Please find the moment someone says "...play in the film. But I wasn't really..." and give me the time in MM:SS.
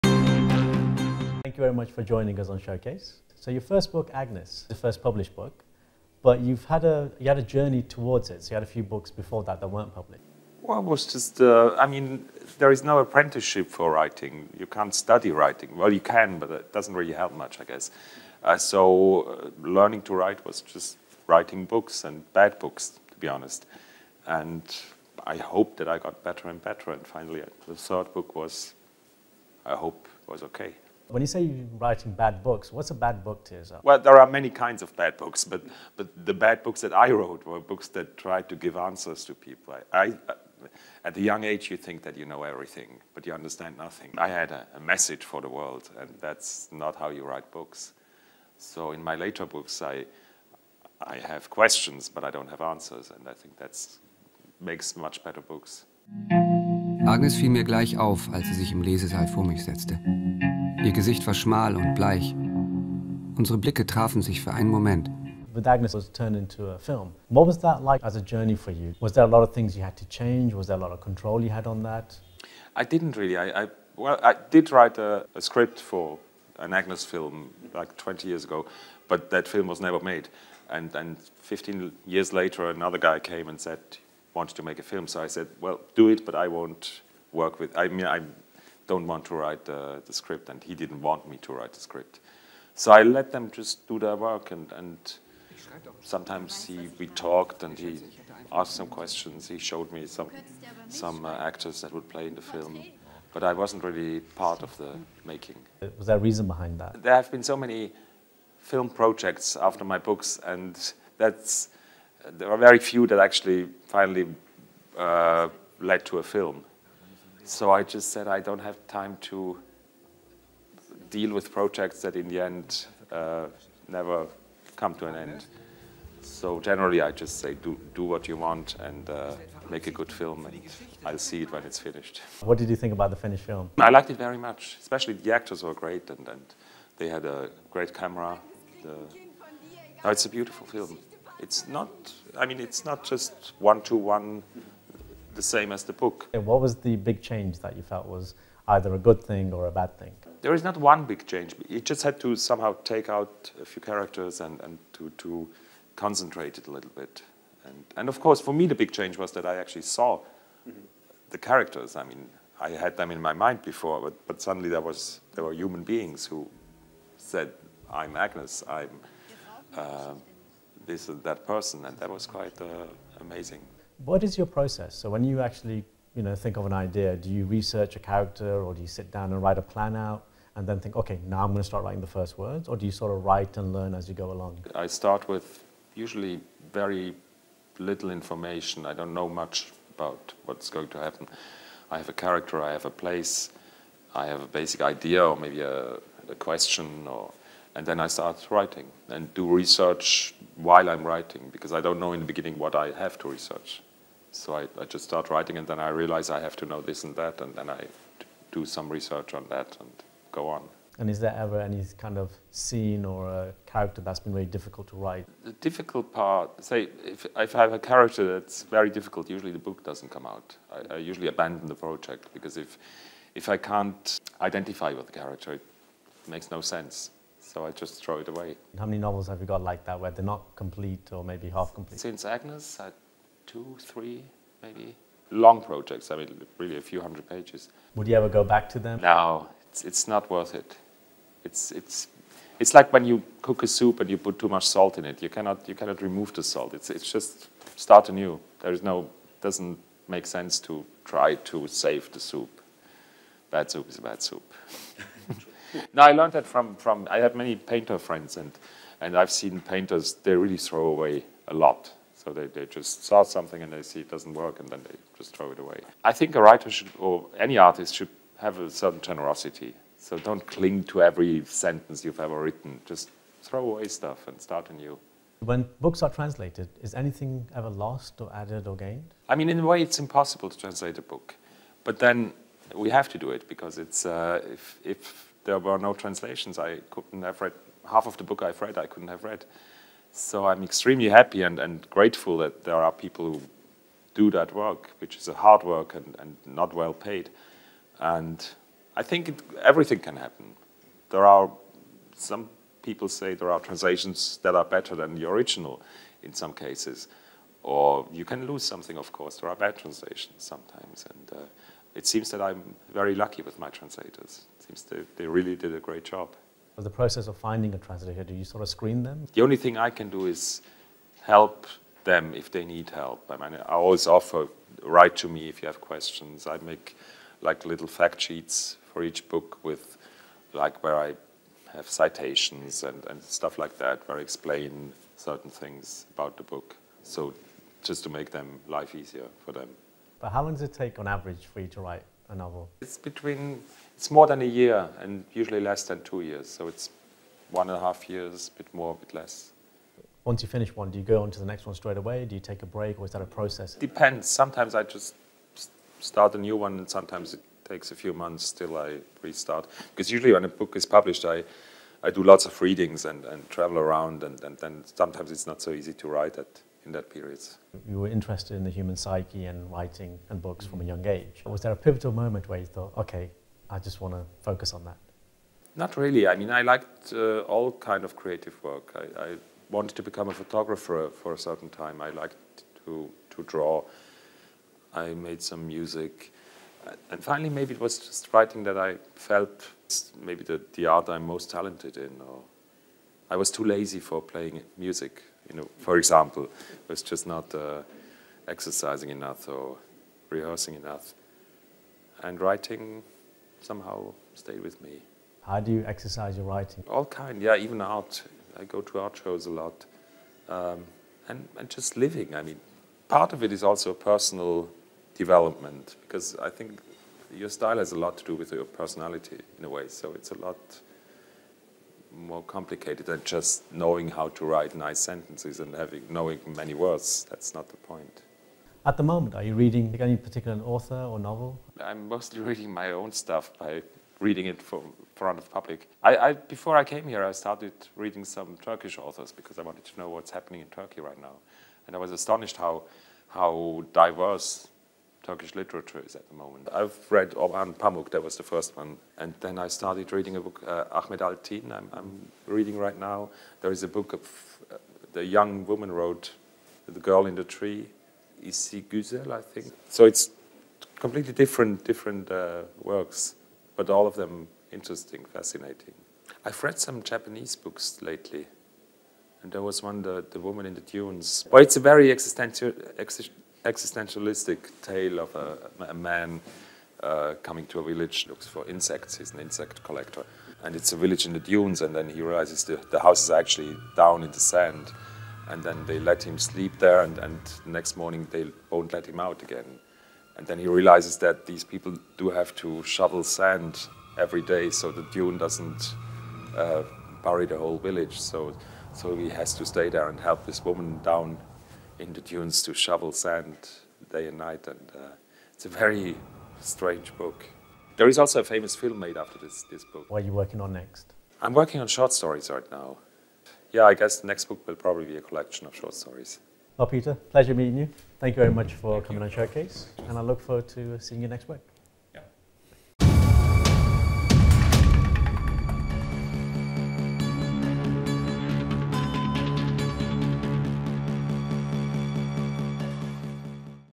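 01:42.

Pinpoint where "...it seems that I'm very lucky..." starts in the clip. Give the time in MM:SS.
05:11.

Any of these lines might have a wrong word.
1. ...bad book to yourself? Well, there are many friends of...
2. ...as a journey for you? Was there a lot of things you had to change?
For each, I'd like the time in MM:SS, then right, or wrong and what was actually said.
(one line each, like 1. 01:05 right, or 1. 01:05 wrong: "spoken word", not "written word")
1. 00:32 wrong: "kinds", not "friends"
2. 01:08 right.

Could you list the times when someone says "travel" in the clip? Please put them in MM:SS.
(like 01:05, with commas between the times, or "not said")
06:03.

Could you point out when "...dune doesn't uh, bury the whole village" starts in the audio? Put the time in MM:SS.
08:15.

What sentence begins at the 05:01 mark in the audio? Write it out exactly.
There are some people say there are translations that are better than the original in some cases.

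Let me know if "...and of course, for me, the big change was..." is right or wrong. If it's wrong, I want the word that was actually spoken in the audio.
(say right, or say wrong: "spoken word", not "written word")
right.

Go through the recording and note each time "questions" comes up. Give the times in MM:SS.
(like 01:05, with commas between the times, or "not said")
00:51, 01:38, 03:16, 05:25.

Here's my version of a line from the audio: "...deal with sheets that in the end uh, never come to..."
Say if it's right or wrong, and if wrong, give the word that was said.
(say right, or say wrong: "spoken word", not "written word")
wrong: "projects", not "sheets".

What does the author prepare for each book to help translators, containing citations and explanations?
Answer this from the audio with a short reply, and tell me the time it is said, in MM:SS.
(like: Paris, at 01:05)
fact sheets, at 05:27.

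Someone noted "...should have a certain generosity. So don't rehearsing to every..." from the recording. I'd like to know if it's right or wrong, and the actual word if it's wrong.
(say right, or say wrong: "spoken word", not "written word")
wrong: "cling", not "rehearsing".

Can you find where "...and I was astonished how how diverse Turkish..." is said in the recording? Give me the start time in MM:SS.
07:21.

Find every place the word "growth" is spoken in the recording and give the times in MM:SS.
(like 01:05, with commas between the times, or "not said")
not said.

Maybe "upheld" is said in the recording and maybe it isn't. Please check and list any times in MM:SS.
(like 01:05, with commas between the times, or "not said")
not said.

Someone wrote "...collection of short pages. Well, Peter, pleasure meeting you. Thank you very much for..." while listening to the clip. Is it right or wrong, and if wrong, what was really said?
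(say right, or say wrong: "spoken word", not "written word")
wrong: "stories", not "pages".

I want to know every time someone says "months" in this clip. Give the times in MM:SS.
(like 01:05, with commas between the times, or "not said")
05:58.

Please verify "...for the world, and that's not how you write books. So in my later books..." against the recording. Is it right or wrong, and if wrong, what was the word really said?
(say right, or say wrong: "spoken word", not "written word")
right.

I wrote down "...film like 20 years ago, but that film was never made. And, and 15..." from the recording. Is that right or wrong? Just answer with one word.
right.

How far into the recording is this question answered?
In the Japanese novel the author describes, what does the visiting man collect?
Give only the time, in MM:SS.
07:59.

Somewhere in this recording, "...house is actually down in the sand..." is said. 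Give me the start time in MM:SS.
08:02.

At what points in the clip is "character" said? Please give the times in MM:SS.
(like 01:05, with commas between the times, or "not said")
02:33, 02:41, 02:57, 03:12, 03:33, 03:37, 03:45.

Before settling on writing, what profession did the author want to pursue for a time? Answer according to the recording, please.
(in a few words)
photographer.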